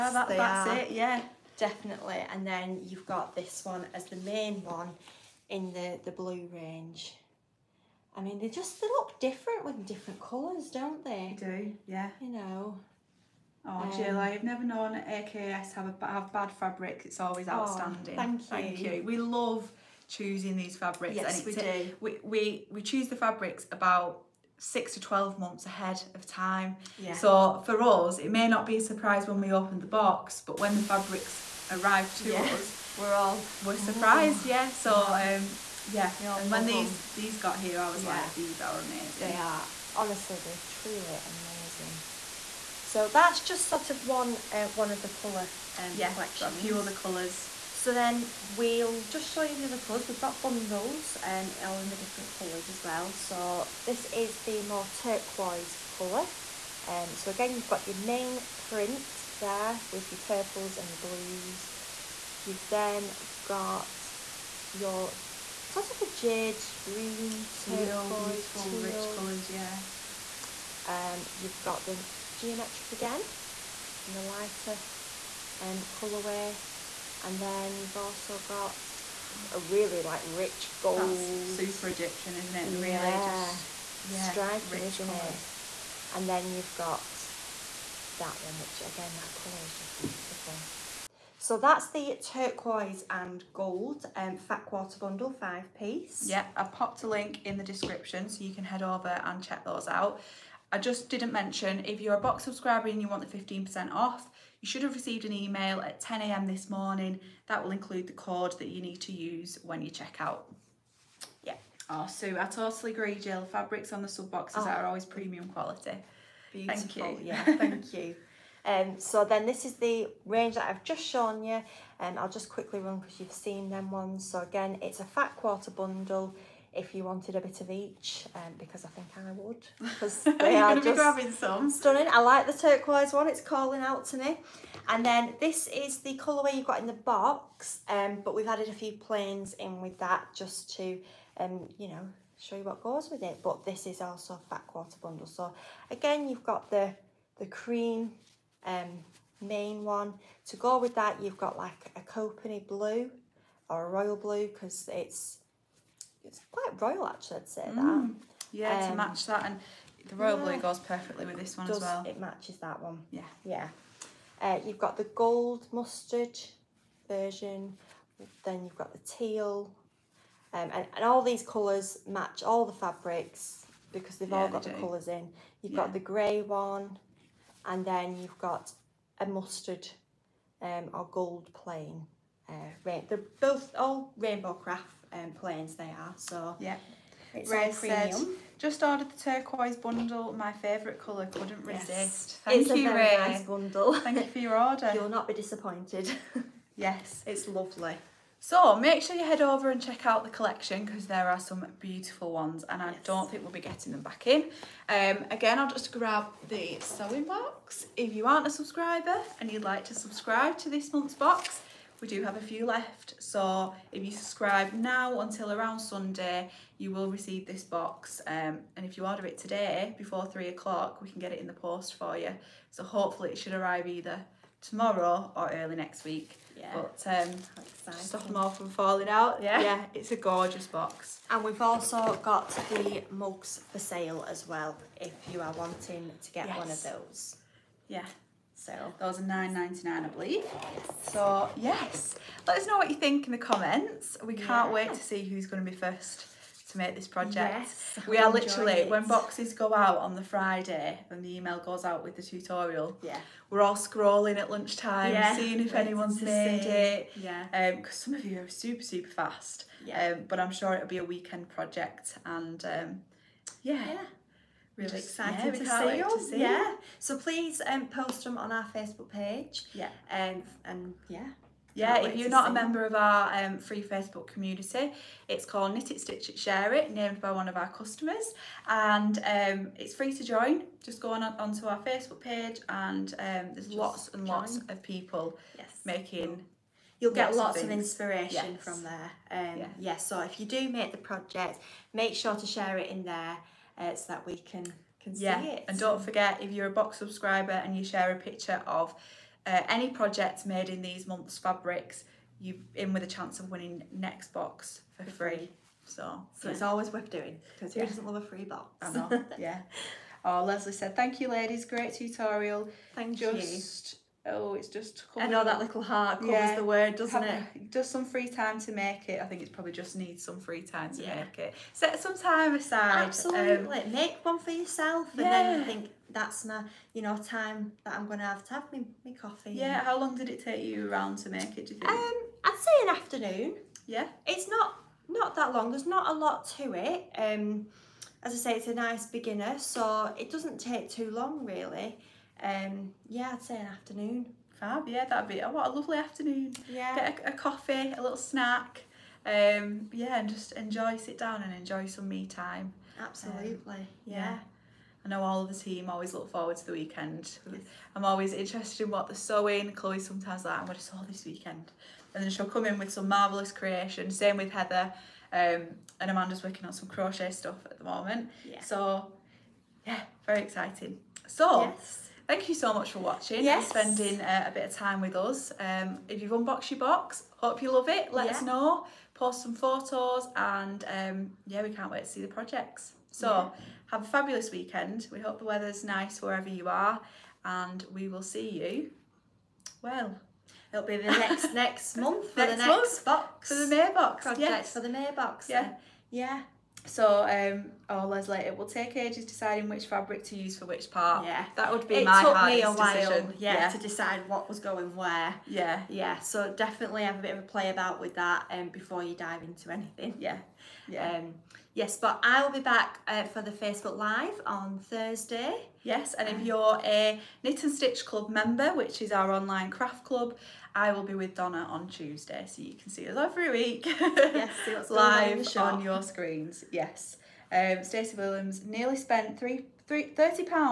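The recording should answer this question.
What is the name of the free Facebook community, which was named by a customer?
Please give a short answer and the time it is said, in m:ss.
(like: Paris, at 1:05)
Knit It, Stitch It, Share It, at 4:35.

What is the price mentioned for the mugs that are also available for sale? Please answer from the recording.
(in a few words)
9.99.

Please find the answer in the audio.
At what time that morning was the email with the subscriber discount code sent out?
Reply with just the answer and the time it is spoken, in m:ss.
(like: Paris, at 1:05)
10 a.m., at 1:45.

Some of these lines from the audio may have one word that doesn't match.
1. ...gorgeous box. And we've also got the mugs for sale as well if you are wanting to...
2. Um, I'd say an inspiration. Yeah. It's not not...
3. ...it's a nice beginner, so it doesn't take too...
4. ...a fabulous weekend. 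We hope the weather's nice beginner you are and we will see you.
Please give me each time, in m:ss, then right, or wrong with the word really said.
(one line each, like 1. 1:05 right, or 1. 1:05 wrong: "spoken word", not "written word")
1. 3:50 right
2. 5:31 wrong: "afternoon", not "inspiration"
3. 5:38 right
4. 6:24 wrong: "wherever", not "beginner".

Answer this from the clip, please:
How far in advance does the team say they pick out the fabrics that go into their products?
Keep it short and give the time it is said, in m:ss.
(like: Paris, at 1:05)
6 to 12 months, at 0:24.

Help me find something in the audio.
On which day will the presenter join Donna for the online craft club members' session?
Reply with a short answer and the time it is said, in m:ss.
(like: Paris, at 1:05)
Tuesday, at 7:01.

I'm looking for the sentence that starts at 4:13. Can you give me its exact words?
Yeah, we're all scrolling at lunchtime, yeah.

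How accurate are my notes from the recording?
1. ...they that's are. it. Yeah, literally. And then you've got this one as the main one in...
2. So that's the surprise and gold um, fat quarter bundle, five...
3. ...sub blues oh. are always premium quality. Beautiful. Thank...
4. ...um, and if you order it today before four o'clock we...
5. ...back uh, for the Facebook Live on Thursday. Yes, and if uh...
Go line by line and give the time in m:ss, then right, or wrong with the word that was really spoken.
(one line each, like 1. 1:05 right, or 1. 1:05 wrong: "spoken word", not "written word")
1. 0:00 wrong: "definitely", not "literally"
2. 1:31 wrong: "turquoise", not "surprise"
3. 1:54 wrong: "boxes", not "blues"
4. 3:38 wrong: "three", not "four"
5. 6:52 right.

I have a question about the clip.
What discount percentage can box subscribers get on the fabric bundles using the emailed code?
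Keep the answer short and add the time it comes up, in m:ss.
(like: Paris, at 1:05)
15%, at 1:43.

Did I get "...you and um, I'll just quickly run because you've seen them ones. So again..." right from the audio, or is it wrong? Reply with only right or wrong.
right.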